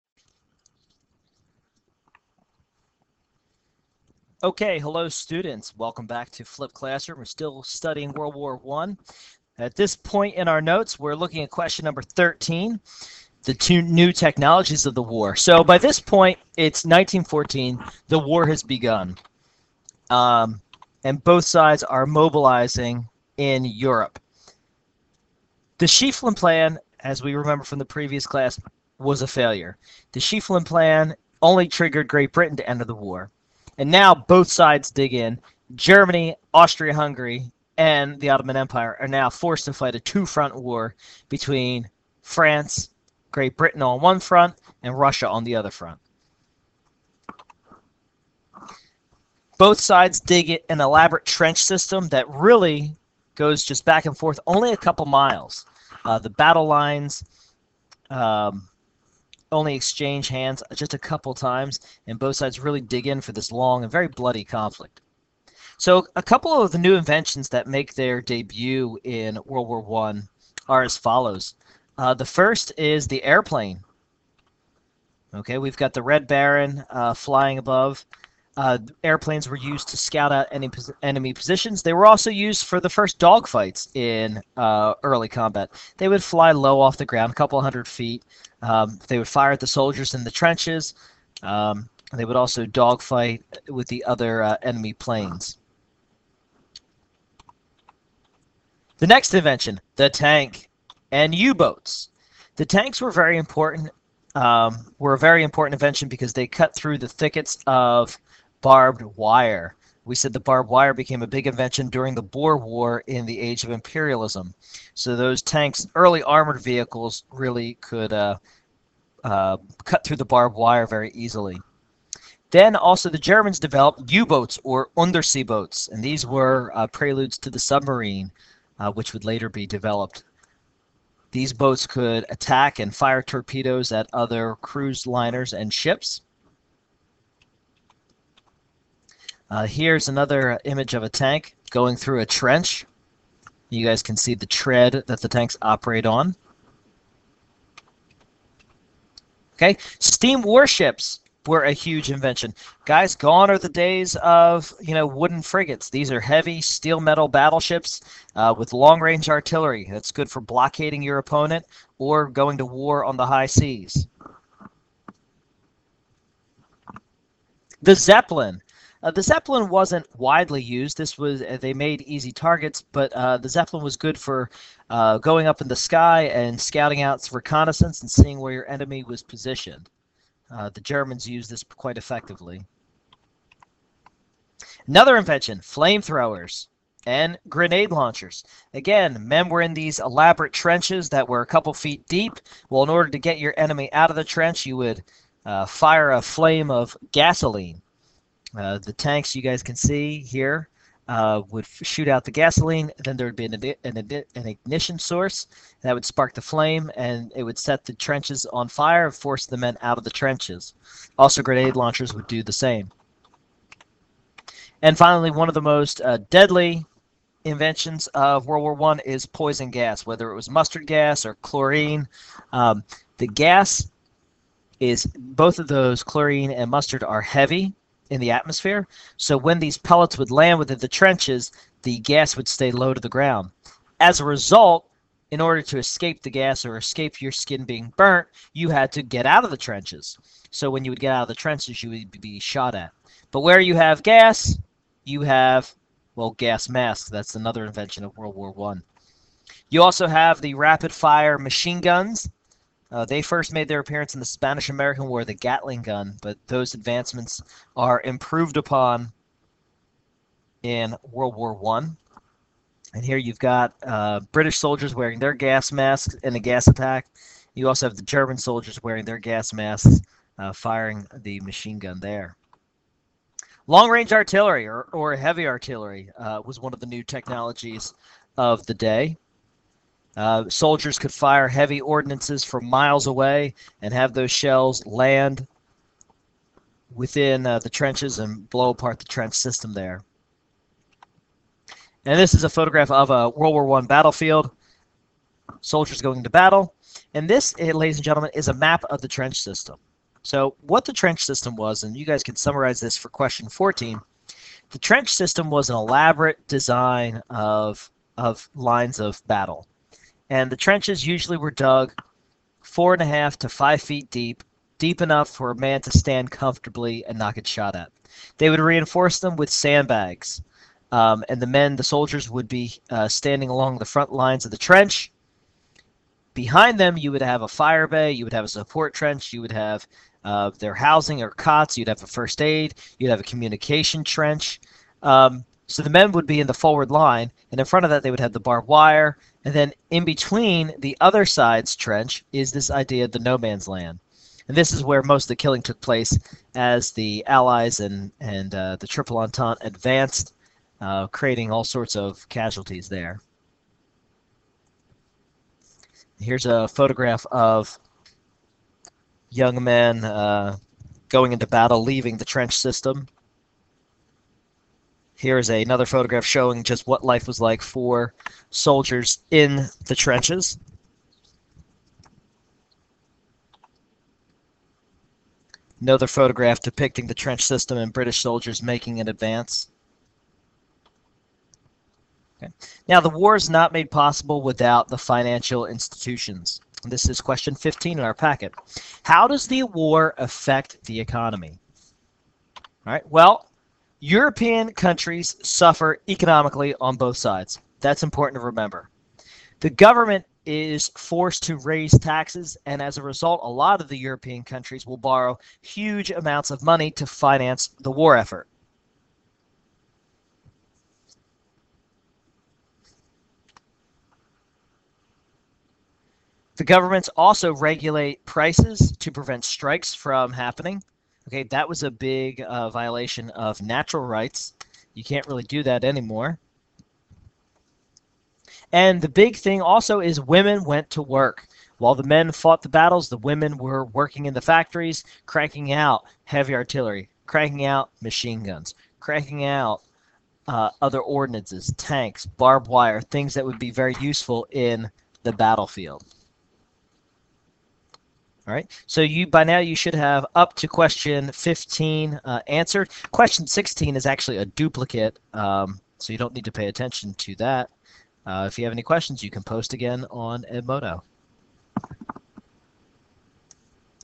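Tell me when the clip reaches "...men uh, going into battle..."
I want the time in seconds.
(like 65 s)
359 s.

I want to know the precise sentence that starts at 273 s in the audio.
Long range artillery or, or heavy artillery uh, was one of the new technologies of the day.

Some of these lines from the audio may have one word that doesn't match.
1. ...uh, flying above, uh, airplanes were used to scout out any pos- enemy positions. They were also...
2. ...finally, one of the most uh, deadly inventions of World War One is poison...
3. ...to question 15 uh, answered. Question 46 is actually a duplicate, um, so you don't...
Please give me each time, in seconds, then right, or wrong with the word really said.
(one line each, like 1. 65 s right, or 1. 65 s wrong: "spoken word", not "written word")
1. 76 s right
2. 214 s right
3. 450 s wrong: "16", not "46".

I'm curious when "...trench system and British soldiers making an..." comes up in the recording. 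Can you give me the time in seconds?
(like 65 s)
377 s.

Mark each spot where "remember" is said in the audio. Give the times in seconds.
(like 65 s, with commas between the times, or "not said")
27 s, 398 s.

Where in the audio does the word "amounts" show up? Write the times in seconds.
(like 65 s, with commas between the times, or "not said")
406 s.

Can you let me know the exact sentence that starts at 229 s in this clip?
So when these pellets would land within the trenches, the gas would stay low to the ground.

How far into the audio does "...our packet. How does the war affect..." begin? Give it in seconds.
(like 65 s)
388 s.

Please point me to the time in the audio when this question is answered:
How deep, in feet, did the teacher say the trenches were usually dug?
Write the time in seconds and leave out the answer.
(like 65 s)
312 s.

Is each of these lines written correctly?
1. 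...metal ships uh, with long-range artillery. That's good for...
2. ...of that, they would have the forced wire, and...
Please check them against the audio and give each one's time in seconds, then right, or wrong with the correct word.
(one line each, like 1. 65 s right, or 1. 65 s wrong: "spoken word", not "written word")
1. 157 s wrong: "battleships", not "ships"
2. 337 s wrong: "barbed", not "forced".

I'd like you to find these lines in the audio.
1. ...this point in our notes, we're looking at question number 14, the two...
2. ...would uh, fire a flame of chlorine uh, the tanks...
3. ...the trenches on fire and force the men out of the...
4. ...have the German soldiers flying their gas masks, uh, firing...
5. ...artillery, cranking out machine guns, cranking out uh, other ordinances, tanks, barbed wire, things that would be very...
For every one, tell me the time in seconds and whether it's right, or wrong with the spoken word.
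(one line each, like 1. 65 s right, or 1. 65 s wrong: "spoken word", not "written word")
1. 9 s wrong: "13", not "14"
2. 194 s wrong: "gasoline", not "chlorine"
3. 207 s right
4. 267 s wrong: "wearing", not "flying"
5. 436 s right.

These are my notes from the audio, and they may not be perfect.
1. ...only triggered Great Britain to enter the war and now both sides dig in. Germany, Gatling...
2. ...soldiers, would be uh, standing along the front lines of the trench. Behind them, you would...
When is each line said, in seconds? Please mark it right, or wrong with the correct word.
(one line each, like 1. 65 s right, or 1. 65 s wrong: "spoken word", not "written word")
1. 31 s wrong: "Austria", not "Gatling"
2. 321 s right.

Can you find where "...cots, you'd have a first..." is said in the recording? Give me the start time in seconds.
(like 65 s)
331 s.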